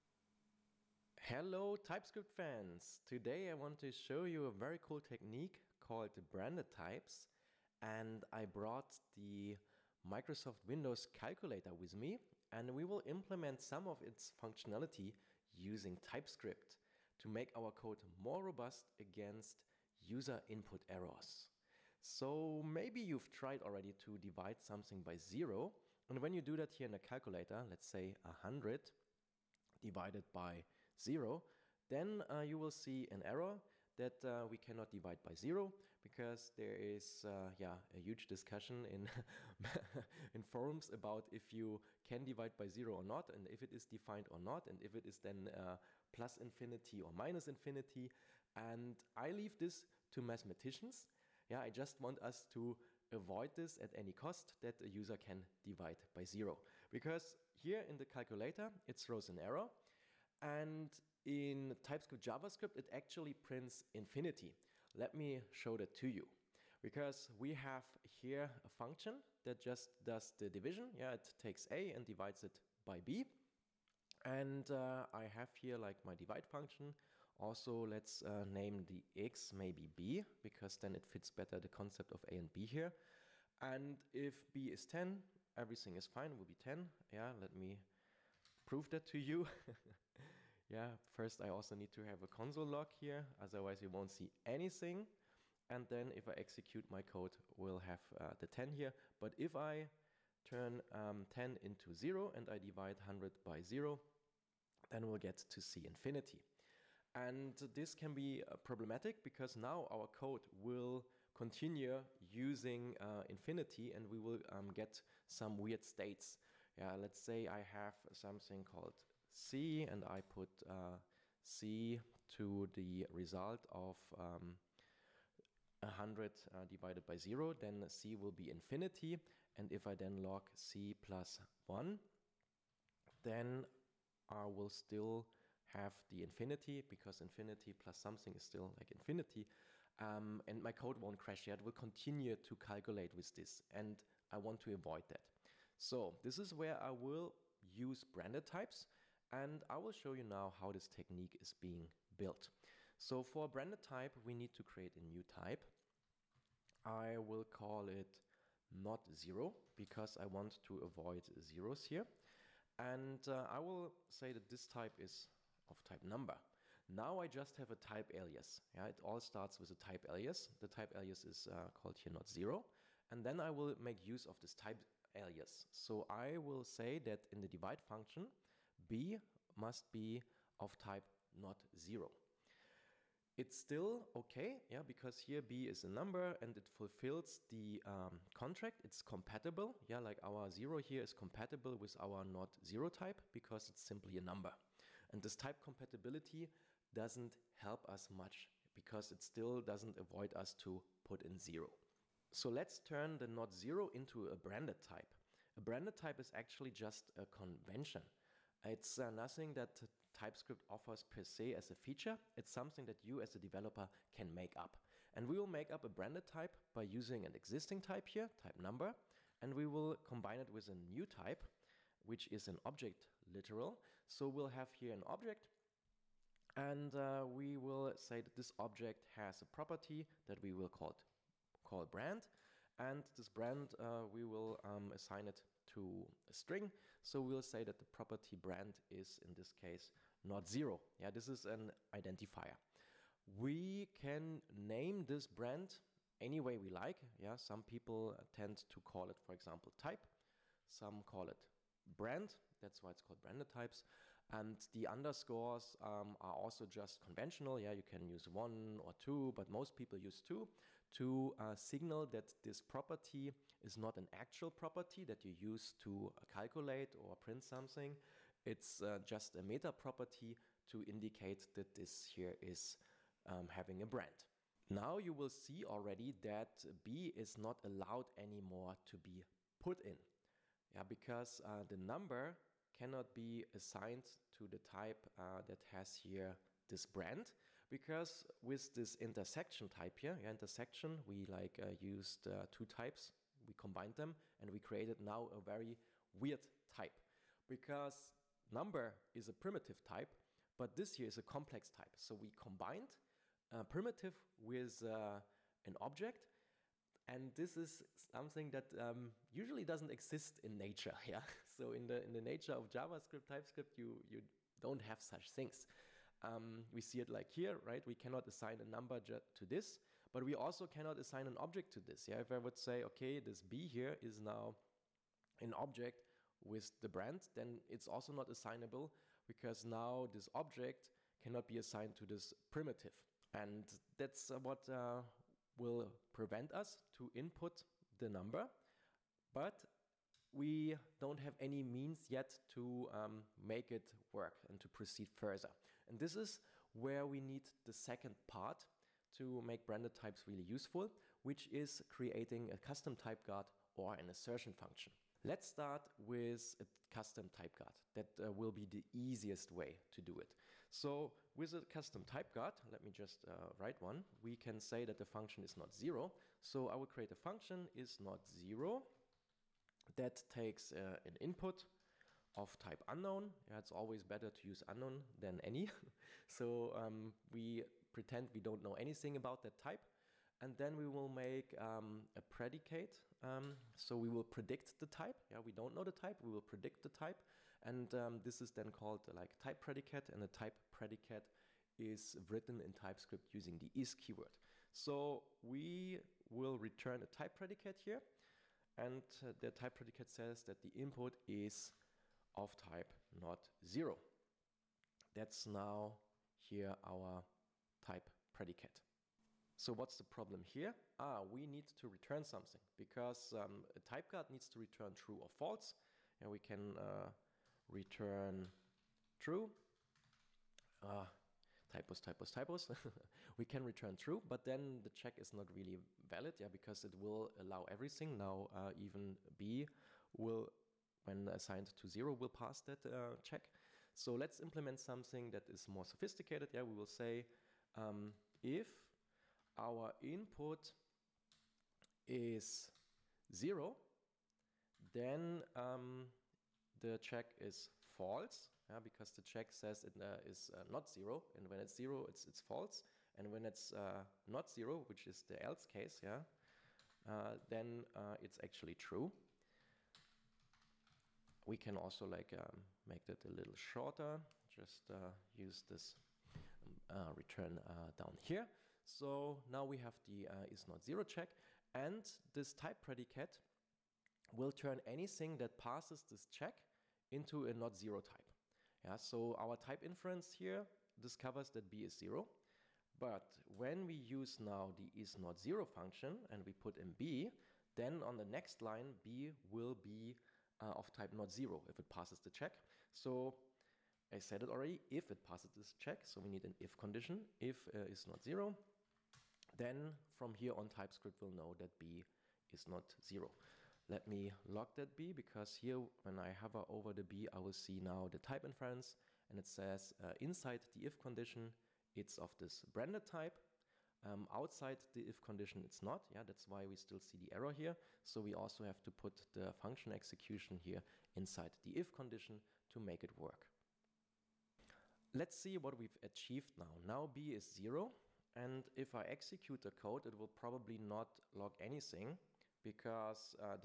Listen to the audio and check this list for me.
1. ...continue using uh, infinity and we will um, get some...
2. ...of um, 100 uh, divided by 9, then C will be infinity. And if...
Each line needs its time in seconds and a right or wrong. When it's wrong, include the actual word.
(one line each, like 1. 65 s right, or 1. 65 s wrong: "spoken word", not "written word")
1. 111 s right
2. 123 s wrong: "0", not "9".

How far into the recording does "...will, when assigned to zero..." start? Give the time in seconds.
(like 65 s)
430 s.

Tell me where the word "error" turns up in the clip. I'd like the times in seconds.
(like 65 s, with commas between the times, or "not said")
20 s, 33 s, 59 s, 517 s.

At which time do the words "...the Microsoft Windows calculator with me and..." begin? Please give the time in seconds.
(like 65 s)
9 s.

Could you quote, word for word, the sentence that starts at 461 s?
We can also like um, make that a little shorter.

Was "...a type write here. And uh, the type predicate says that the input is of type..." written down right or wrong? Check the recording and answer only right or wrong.
wrong.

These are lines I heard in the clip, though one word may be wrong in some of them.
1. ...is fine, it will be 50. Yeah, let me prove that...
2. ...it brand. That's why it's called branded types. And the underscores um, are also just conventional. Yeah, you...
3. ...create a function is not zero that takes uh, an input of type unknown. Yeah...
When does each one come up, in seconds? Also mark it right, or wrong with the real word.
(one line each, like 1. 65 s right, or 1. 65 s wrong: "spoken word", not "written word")
1. 85 s wrong: "10", not "50"
2. 251 s right
3. 366 s right.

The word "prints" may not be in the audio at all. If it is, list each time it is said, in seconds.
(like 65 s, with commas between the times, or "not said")
63 s, 267 s.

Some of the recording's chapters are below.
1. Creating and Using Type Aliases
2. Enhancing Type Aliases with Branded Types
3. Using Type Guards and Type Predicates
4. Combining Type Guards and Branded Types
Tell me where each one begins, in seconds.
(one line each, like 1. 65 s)
1. 152 s
2. 214 s
3. 361 s
4. 524 s.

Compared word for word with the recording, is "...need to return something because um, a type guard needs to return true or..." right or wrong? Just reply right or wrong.
right.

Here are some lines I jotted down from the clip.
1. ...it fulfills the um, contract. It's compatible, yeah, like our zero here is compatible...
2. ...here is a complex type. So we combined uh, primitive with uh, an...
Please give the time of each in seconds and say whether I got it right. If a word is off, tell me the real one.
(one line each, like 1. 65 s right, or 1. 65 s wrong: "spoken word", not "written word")
1. 186 s right
2. 300 s right.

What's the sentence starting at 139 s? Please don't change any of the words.
Um, and my code won't crash yet.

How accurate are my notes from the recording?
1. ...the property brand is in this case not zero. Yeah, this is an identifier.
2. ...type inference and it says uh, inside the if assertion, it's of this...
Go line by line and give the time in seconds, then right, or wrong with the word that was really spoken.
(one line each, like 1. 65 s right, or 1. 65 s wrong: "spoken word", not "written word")
1. 237 s right
2. 508 s wrong: "condition", not "assertion".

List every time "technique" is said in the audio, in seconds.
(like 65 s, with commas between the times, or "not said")
4 s, 150 s.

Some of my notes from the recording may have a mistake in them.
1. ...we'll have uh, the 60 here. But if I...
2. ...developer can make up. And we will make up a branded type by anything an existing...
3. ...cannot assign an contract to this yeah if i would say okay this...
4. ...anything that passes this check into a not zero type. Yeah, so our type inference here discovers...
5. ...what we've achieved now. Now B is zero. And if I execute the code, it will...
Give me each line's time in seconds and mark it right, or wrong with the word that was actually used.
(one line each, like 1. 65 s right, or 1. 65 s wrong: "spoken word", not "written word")
1. 97 s wrong: "10", not "60"
2. 213 s wrong: "using", not "anything"
3. 320 s wrong: "object", not "contract"
4. 474 s right
5. 525 s right.